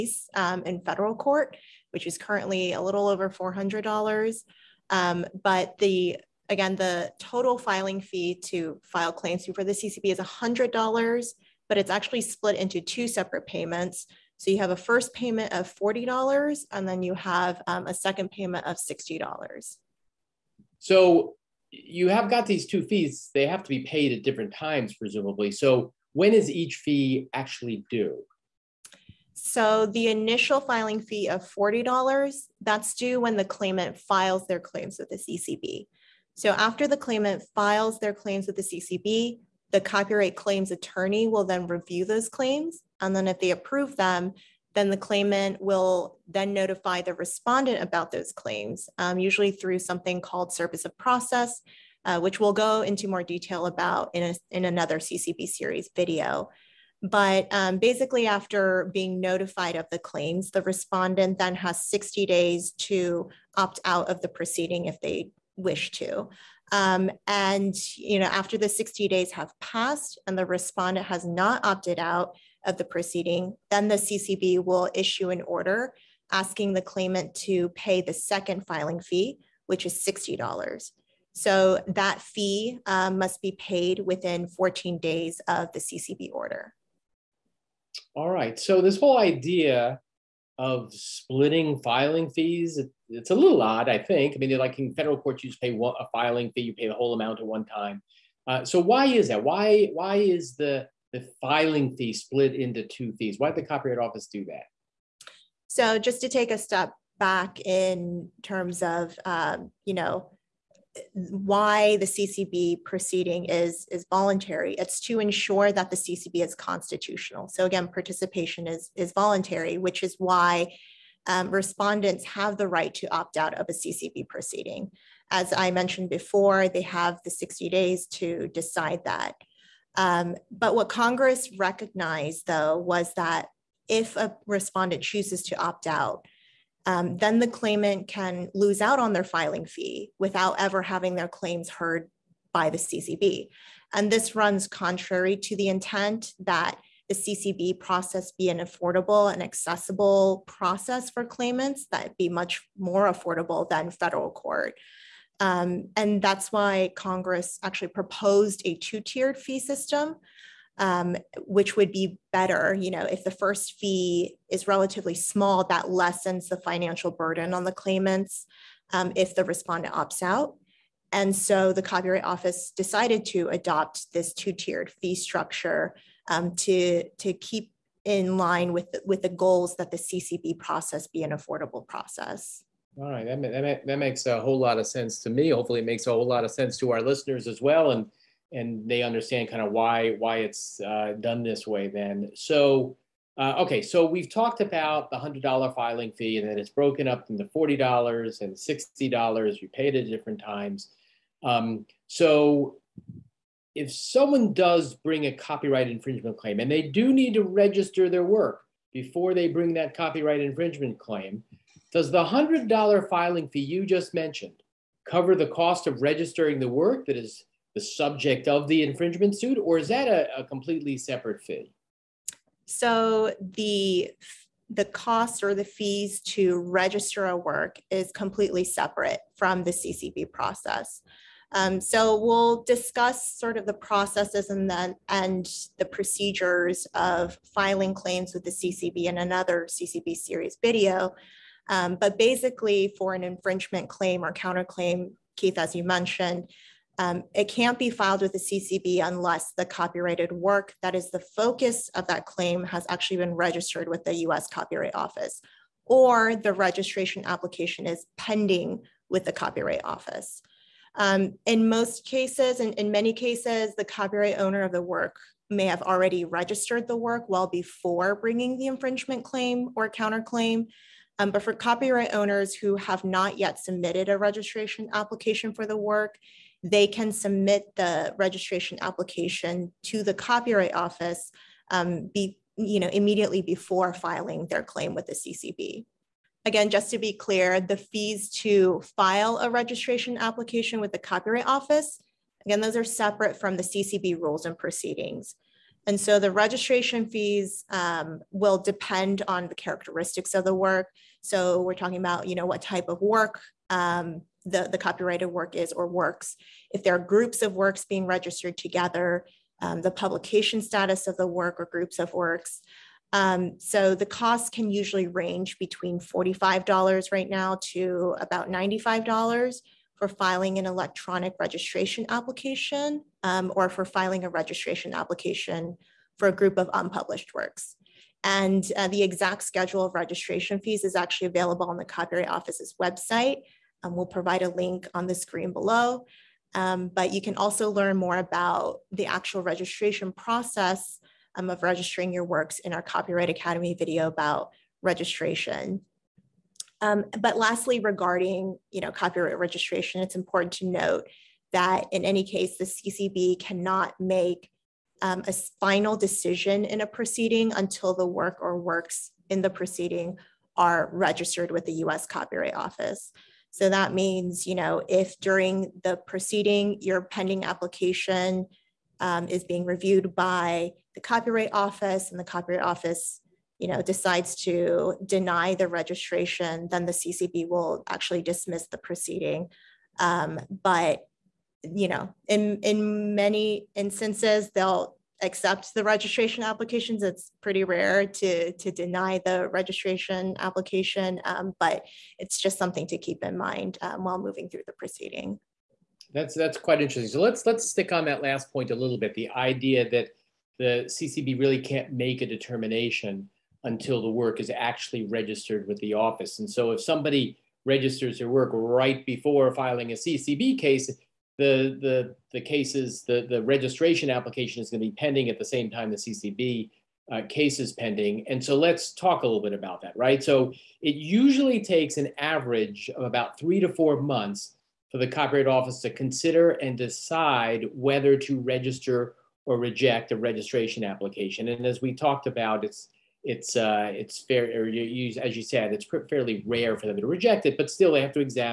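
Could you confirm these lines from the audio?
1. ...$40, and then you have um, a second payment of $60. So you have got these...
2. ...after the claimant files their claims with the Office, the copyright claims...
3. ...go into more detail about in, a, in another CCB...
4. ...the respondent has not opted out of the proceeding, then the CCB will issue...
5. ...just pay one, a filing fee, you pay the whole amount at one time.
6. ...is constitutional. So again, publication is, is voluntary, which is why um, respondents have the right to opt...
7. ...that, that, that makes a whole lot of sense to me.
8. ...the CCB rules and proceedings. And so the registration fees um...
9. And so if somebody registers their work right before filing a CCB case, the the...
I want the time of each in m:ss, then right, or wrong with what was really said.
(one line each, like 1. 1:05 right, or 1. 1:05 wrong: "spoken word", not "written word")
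1. 0:15 right
2. 0:36 wrong: "CCB", not "Office"
3. 0:52 right
4. 1:10 right
5. 1:35 right
6. 1:56 wrong: "participation", not "publication"
7. 3:03 right
8. 4:53 right
9. 6:46 right.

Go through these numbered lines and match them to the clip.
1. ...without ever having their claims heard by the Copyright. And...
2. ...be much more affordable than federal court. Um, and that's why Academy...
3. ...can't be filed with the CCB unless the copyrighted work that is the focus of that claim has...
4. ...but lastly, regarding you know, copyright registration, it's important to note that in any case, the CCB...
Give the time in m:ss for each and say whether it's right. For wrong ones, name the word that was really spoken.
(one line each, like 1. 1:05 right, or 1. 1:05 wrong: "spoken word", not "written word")
1. 2:20 wrong: "CCB", not "Copyright"
2. 2:32 wrong: "Congress", not "Academy"
3. 4:07 right
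4. 5:47 right.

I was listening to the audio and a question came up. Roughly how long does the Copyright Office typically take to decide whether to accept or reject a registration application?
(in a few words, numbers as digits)
3 to 4 months.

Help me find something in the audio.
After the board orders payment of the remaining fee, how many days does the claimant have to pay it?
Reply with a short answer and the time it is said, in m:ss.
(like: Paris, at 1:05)
14 days, at 1:24.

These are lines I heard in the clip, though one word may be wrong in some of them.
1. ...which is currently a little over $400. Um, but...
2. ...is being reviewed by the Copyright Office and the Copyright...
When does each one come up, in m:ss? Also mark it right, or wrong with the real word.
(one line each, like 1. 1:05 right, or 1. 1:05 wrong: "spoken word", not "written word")
1. 0:01 right
2. 6:09 right.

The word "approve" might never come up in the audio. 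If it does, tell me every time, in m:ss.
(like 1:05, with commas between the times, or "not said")
0:43.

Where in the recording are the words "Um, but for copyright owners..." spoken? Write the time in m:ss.
4:31.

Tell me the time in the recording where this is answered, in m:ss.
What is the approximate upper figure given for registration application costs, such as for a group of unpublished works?
5:18.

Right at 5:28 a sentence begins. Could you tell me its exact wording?
And uh, the exact schedule of registration fees is actually available on the Copyright Office's website.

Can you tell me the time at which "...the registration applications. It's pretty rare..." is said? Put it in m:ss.
6:25.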